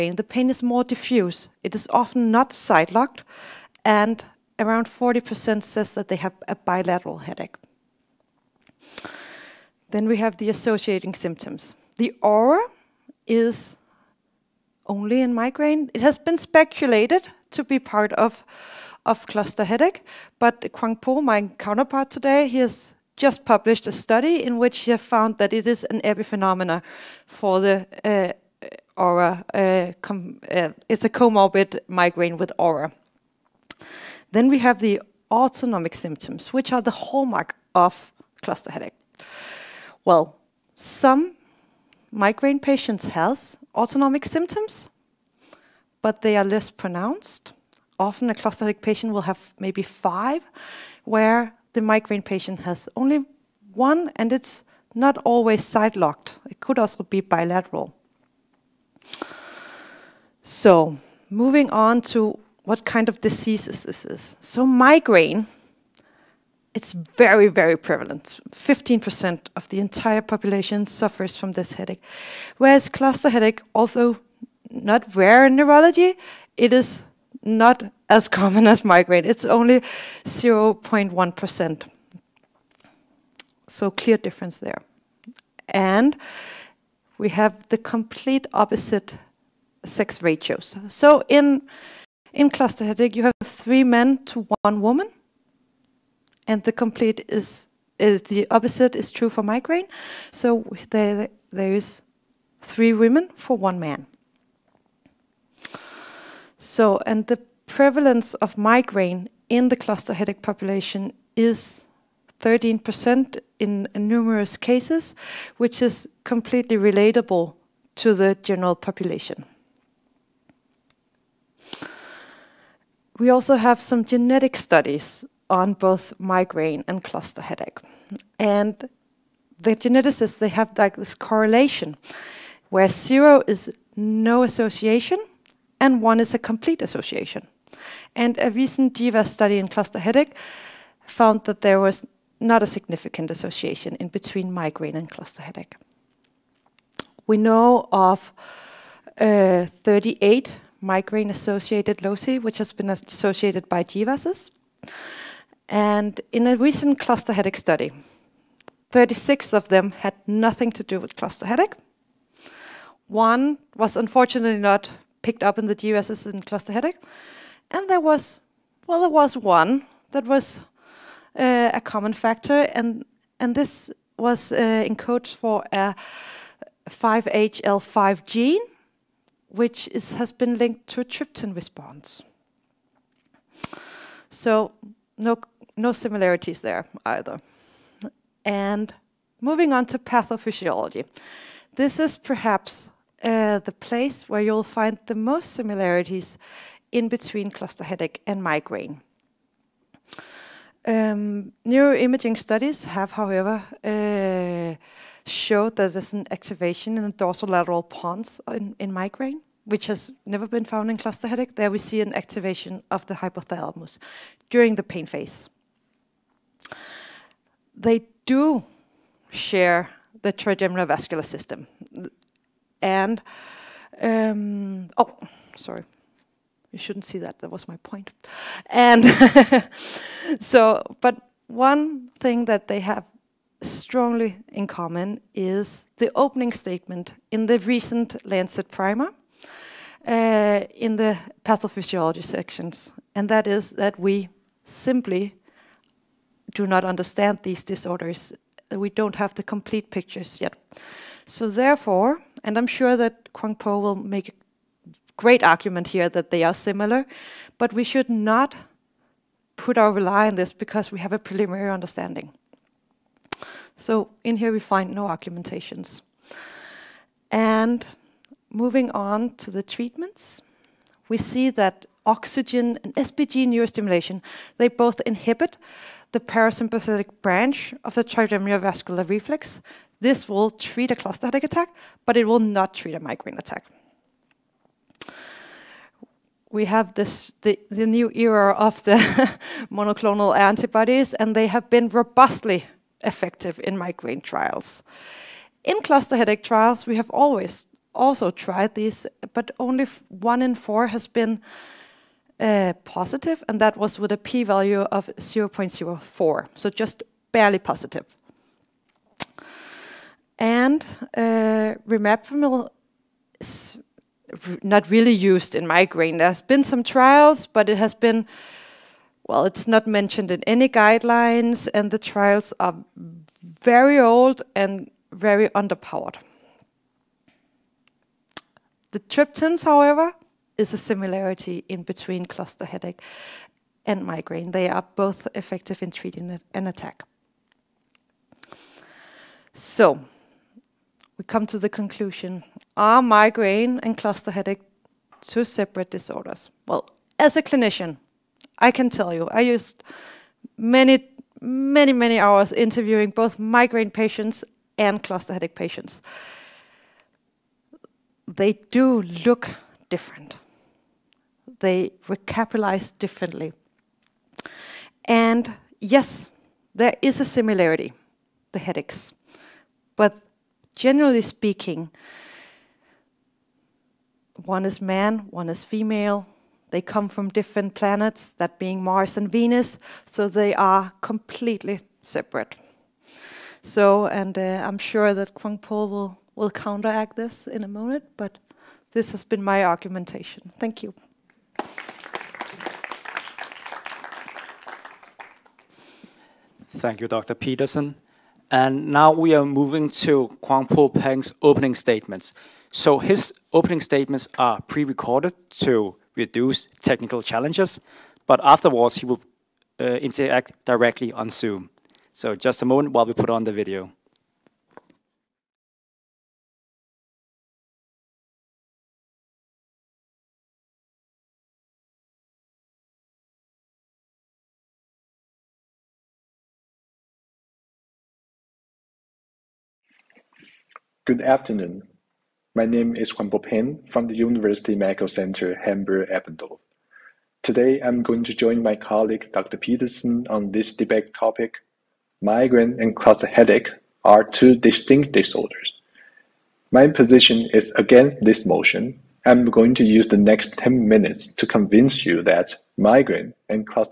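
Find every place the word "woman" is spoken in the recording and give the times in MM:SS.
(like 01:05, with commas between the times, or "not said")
01:34.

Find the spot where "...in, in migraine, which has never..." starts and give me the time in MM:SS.
03:28.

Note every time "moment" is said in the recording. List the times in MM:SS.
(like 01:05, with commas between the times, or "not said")
06:27, 06:52.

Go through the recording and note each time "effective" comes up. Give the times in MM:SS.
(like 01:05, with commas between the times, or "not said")
04:53, 05:35.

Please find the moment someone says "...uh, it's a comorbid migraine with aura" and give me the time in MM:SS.
00:30.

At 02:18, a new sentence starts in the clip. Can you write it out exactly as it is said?
And a recent GWAS study in cluster headache found that there was not a significant association in between migraine and cluster headache.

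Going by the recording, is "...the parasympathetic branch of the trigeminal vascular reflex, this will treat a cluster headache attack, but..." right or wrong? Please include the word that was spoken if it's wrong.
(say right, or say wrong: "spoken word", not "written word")
right.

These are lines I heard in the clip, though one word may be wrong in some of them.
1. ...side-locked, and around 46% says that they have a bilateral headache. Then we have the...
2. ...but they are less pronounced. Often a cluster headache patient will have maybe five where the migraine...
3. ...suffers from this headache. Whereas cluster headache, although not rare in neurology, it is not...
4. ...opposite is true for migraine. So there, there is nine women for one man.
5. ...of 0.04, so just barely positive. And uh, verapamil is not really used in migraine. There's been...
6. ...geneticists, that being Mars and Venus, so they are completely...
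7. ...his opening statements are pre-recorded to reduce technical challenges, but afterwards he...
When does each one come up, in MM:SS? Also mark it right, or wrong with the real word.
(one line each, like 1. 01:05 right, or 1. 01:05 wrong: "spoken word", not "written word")
1. 00:02 wrong: "40", not "46"
2. 00:46 right
3. 01:10 right
4. 01:38 wrong: "three", not "nine"
5. 05:04 right
6. 06:17 wrong: "planets", not "geneticists"
7. 06:42 right.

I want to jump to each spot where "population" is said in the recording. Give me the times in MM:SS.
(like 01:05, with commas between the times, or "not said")
01:10, 01:50, 01:58.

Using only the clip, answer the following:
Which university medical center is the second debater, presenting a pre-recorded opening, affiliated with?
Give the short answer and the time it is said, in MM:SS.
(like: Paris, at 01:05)
University Medical Center Hamburg-Eppendorf, at 07:14.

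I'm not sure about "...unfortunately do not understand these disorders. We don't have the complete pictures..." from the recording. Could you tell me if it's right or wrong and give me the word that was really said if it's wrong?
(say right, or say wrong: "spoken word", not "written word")
wrong: "simply", not "unfortunately".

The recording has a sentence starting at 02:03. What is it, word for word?
We also have some genetic studies on both migraine and cluster headache.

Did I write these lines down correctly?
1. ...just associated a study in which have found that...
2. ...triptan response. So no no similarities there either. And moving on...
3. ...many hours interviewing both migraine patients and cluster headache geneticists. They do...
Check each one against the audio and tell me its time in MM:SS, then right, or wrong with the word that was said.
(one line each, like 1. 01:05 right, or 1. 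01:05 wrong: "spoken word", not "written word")
1. 00:23 wrong: "published", not "associated"
2. 03:01 right
3. 05:51 wrong: "patients", not "geneticists".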